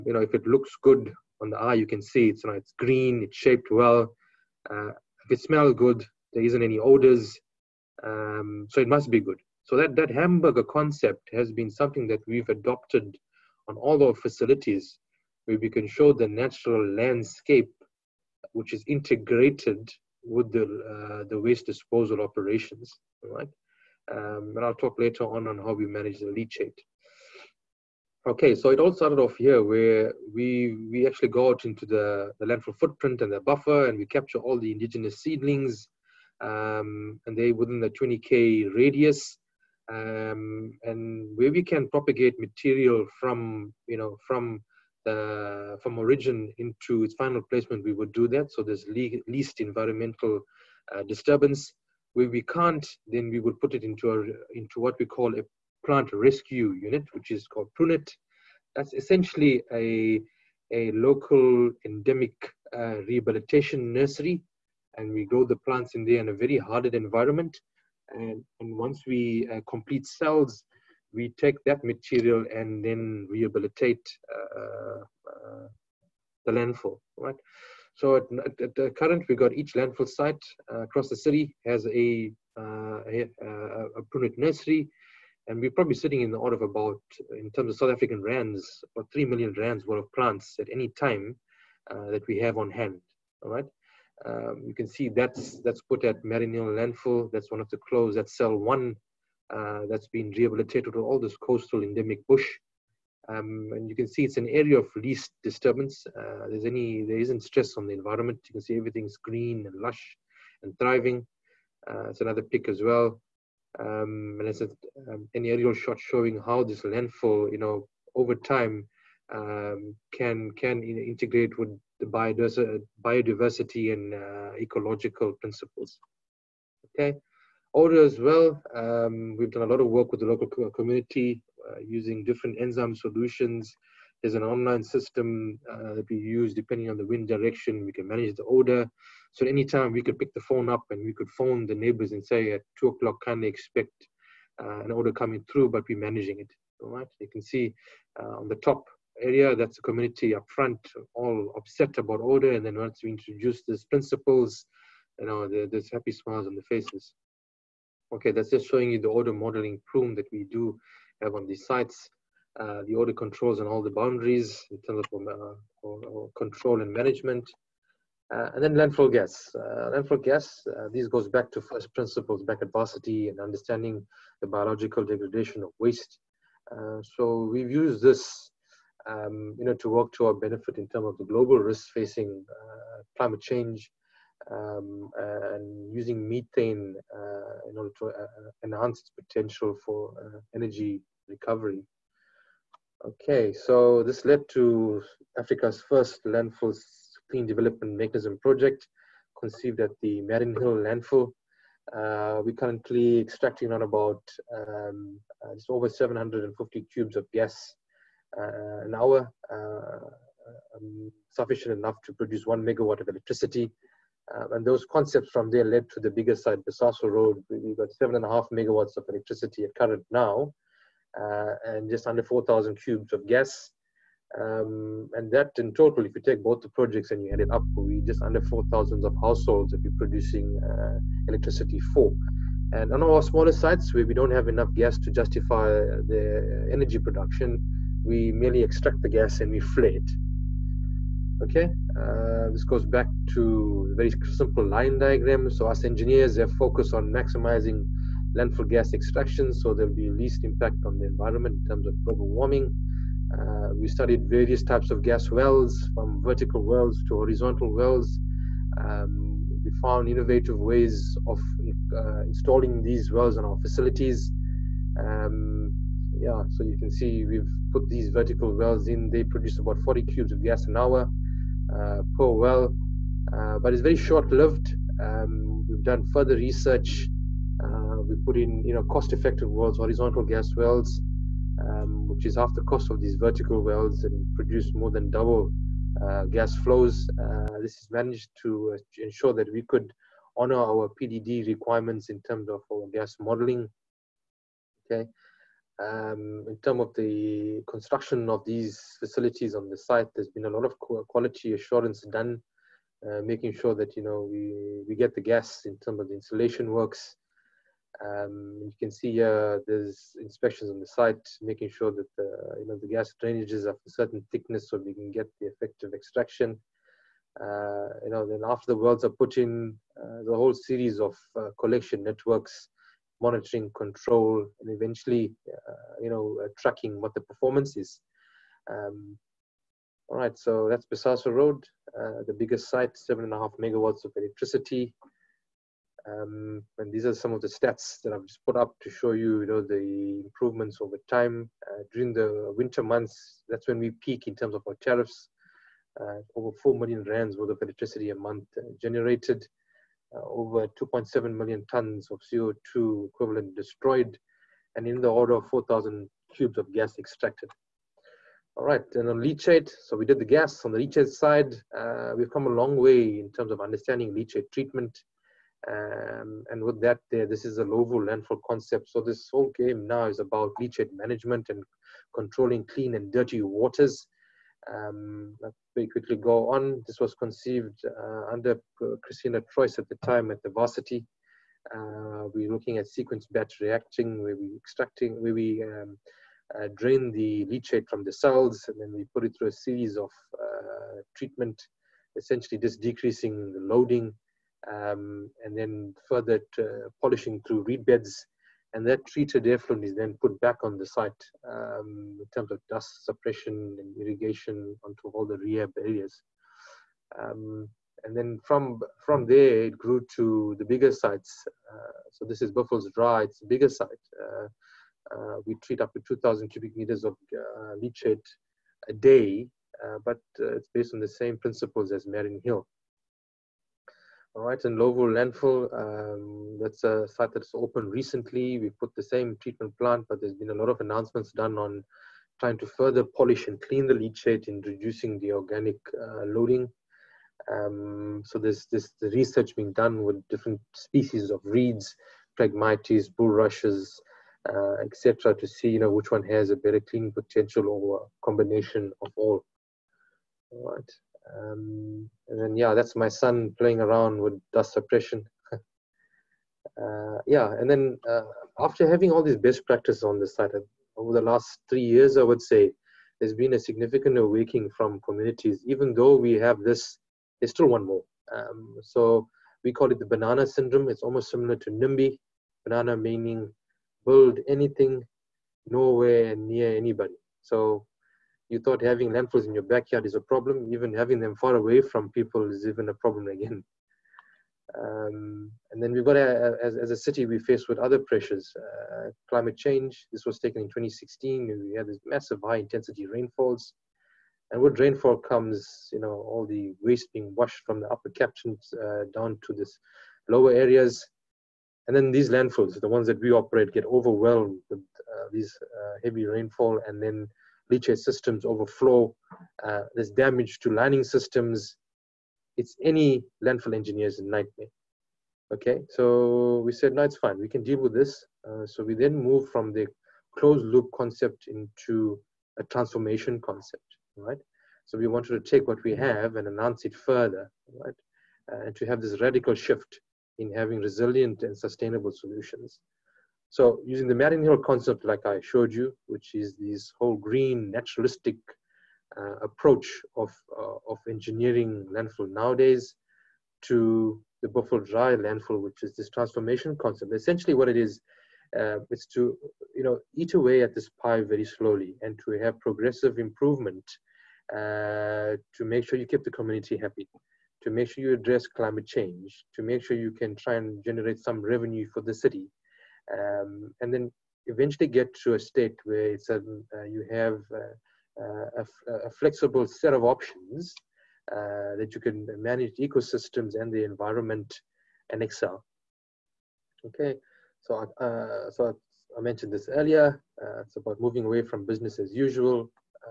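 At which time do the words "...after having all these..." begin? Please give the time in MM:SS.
07:38.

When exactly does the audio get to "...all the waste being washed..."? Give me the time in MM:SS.
08:16.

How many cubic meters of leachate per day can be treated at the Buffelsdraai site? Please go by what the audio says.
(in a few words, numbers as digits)
2,000.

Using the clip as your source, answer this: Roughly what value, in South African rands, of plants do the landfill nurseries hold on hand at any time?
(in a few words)
3 million rands.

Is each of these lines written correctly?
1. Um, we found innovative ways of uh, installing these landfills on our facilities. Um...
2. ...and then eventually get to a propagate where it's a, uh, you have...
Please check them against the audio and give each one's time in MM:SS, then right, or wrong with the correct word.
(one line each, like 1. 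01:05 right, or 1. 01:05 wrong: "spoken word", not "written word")
1. 04:18 wrong: "wells", not "landfills"
2. 09:23 wrong: "state", not "propagate".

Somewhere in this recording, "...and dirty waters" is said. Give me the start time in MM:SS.
06:12.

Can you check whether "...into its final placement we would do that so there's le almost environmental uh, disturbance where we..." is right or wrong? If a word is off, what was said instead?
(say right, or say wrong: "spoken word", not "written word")
wrong: "least", not "almost".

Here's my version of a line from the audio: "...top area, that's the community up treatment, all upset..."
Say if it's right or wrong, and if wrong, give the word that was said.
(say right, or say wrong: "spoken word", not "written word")
wrong: "front", not "treatment".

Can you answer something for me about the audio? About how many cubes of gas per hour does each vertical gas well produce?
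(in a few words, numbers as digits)
40.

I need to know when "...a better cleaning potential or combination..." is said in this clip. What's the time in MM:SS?
07:26.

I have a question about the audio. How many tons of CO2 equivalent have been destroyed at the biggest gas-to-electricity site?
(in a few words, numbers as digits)
2.7 million.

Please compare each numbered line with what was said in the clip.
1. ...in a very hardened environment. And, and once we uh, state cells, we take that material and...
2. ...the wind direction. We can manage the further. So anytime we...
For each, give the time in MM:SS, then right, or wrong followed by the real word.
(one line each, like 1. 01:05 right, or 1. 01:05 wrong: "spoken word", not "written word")
1. 01:06 wrong: "complete", not "state"
2. 02:16 wrong: "order", not "further".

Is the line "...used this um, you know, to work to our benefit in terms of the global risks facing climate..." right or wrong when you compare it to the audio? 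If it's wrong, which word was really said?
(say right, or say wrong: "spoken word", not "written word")
right.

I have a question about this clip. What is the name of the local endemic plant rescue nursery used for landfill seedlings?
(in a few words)
PRUNET.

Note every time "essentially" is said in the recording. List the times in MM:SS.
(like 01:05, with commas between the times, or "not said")
00:58, 06:32, 09:07.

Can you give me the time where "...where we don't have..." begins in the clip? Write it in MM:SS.
03:53.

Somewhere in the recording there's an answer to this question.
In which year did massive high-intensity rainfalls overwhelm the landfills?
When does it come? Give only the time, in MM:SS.
08:10.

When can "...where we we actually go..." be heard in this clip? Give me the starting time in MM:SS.
00:29.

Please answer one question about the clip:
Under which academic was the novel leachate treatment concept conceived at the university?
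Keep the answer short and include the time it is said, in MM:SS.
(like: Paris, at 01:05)
Christina Trois, at 06:19.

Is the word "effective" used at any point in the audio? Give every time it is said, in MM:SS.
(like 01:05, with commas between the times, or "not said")
04:38, 05:15.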